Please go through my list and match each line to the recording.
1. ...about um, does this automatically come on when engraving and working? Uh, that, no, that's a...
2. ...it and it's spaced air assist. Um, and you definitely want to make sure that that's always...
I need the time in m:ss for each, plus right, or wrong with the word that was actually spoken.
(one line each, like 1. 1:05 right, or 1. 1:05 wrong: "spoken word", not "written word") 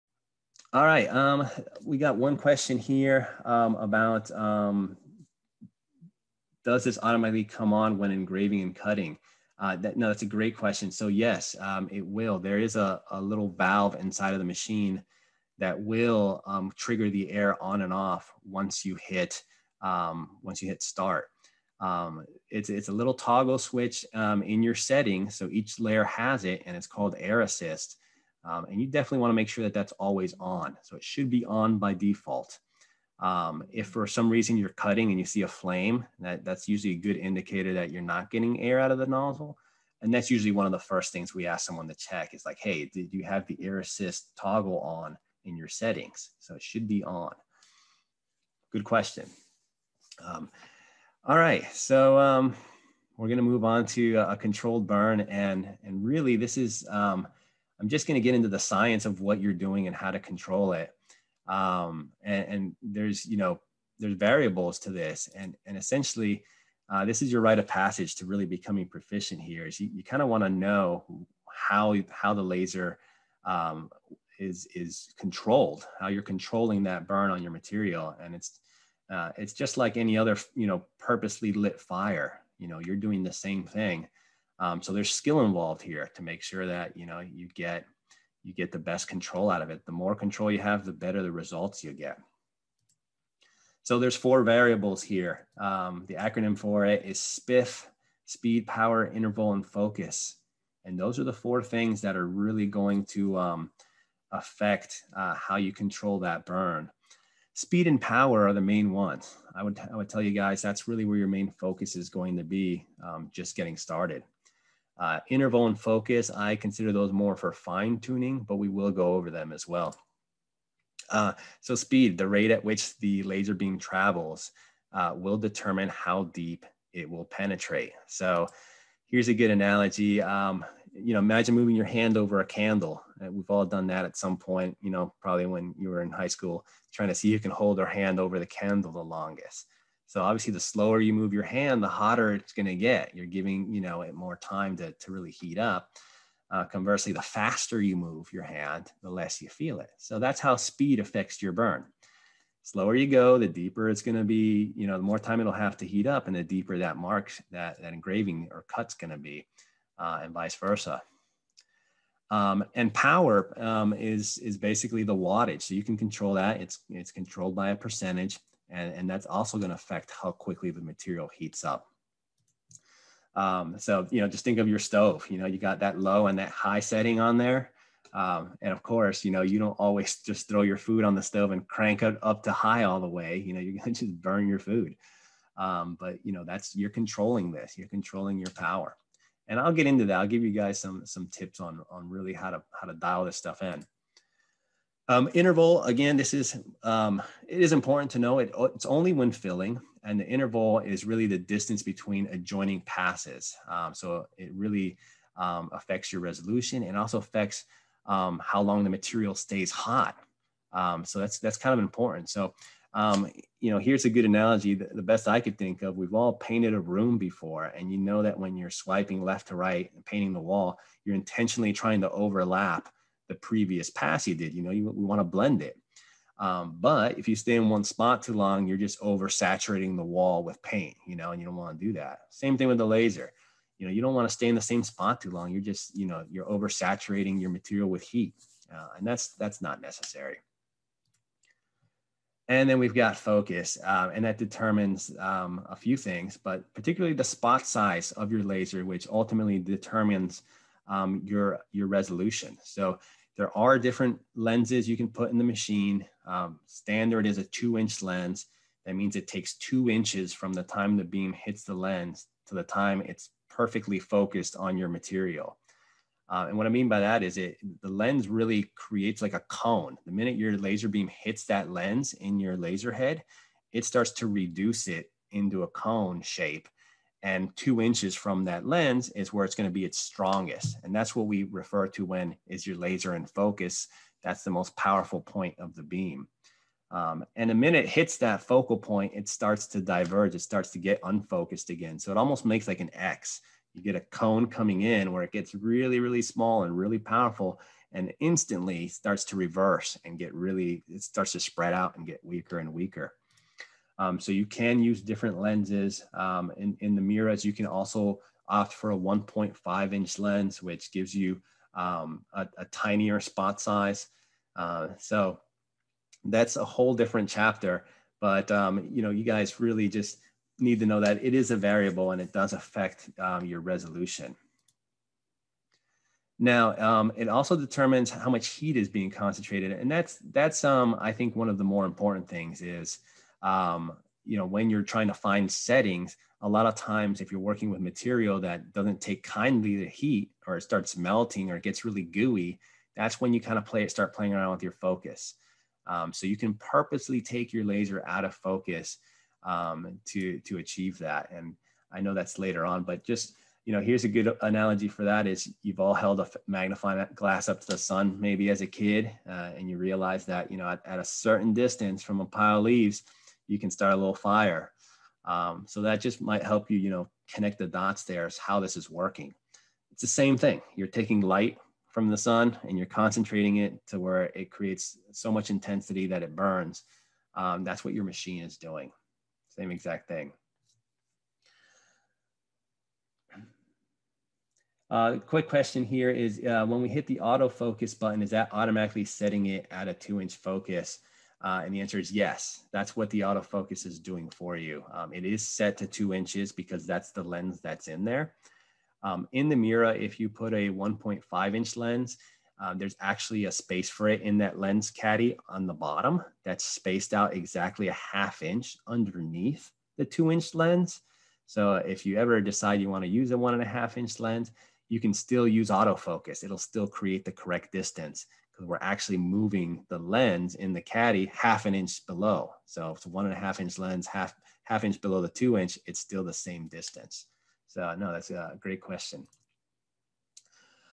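1. 0:03 wrong: "cutting", not "working"
2. 0:26 wrong: "called", not "spaced".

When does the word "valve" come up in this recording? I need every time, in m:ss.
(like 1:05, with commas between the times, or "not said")
0:13.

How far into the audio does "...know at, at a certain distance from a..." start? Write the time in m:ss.
6:00.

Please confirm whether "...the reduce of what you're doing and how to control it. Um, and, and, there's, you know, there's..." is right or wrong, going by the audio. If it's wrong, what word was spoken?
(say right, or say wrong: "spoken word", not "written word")
wrong: "science", not "reduce".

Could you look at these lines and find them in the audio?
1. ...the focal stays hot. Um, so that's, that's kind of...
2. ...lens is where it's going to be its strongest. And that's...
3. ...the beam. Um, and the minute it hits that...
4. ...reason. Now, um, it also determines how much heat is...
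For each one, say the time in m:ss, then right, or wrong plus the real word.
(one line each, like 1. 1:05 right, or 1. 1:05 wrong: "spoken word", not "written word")
1. 3:28 wrong: "material", not "focal"
2. 4:38 right
3. 4:45 right
4. 5:23 wrong: "resolution", not "reason".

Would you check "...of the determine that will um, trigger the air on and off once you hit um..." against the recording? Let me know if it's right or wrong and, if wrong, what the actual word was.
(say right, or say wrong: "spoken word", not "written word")
wrong: "machine", not "determine".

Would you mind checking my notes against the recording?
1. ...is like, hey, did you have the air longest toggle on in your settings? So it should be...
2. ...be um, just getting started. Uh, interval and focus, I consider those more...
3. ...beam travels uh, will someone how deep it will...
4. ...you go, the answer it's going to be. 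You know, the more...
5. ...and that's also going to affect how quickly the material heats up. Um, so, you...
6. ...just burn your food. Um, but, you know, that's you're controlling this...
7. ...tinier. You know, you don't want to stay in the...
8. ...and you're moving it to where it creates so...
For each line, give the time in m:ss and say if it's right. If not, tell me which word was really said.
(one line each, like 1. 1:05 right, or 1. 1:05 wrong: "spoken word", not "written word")
1. 0:42 wrong: "assist", not "longest"
2. 1:52 right
3. 2:03 wrong: "determine", not "someone"
4. 2:32 wrong: "deeper", not "answer"
5. 2:48 right
6. 3:04 right
7. 3:52 wrong: "laser", not "tinier"
8. 6:12 wrong: "concentrating", not "moving".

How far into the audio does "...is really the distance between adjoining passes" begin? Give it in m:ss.
3:20.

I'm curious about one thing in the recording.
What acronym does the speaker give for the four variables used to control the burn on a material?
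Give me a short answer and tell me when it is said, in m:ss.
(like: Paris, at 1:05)
SPIF, at 1:37.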